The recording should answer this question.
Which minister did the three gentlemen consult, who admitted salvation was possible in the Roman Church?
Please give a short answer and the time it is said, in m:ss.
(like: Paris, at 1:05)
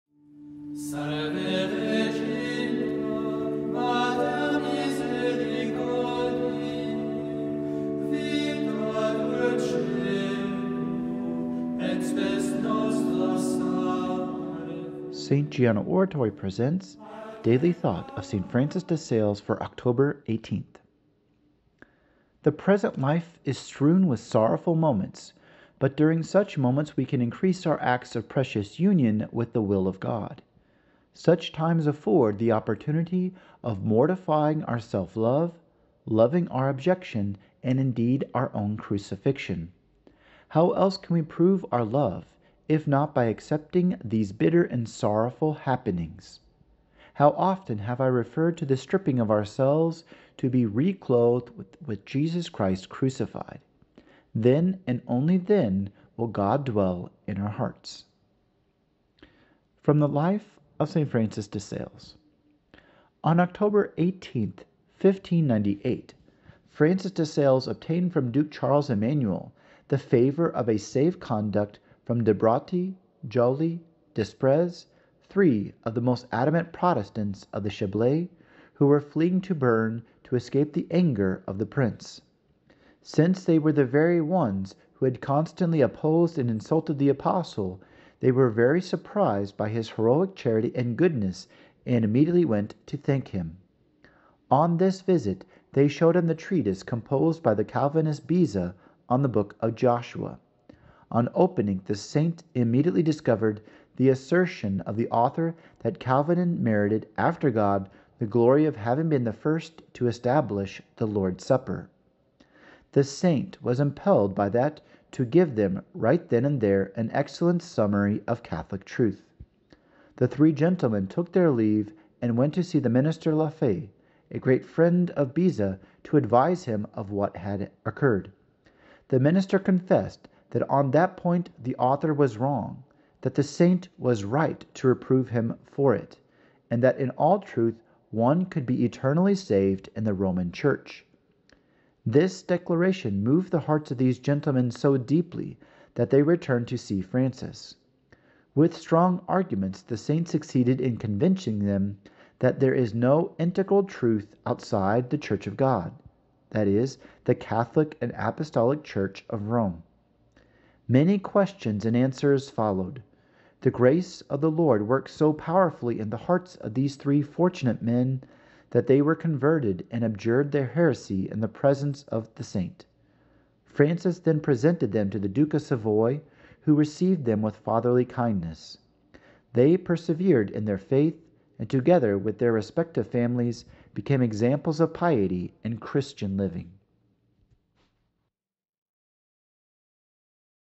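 La Faye, at 2:03.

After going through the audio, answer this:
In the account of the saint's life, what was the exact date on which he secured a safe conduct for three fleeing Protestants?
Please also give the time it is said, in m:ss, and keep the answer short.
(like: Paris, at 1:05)
October 18, 1598, at 1:03.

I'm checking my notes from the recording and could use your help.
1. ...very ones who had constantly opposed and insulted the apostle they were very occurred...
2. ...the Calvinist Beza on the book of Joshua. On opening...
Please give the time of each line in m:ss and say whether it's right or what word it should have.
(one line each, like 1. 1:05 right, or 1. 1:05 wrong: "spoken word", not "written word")
1. 1:23 wrong: "surprised", not "occurred"
2. 1:37 right.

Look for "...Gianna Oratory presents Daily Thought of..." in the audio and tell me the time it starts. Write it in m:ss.
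0:15.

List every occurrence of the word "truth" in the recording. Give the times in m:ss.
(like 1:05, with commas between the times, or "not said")
1:58, 2:17, 2:33.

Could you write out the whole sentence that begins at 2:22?
This declaration moved the hearts of these gentlemen so deeply that they returned to see Francis.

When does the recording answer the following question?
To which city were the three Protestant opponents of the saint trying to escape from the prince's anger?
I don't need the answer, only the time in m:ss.
1:19.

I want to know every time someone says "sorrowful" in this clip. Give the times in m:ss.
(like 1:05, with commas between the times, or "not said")
0:24, 0:44.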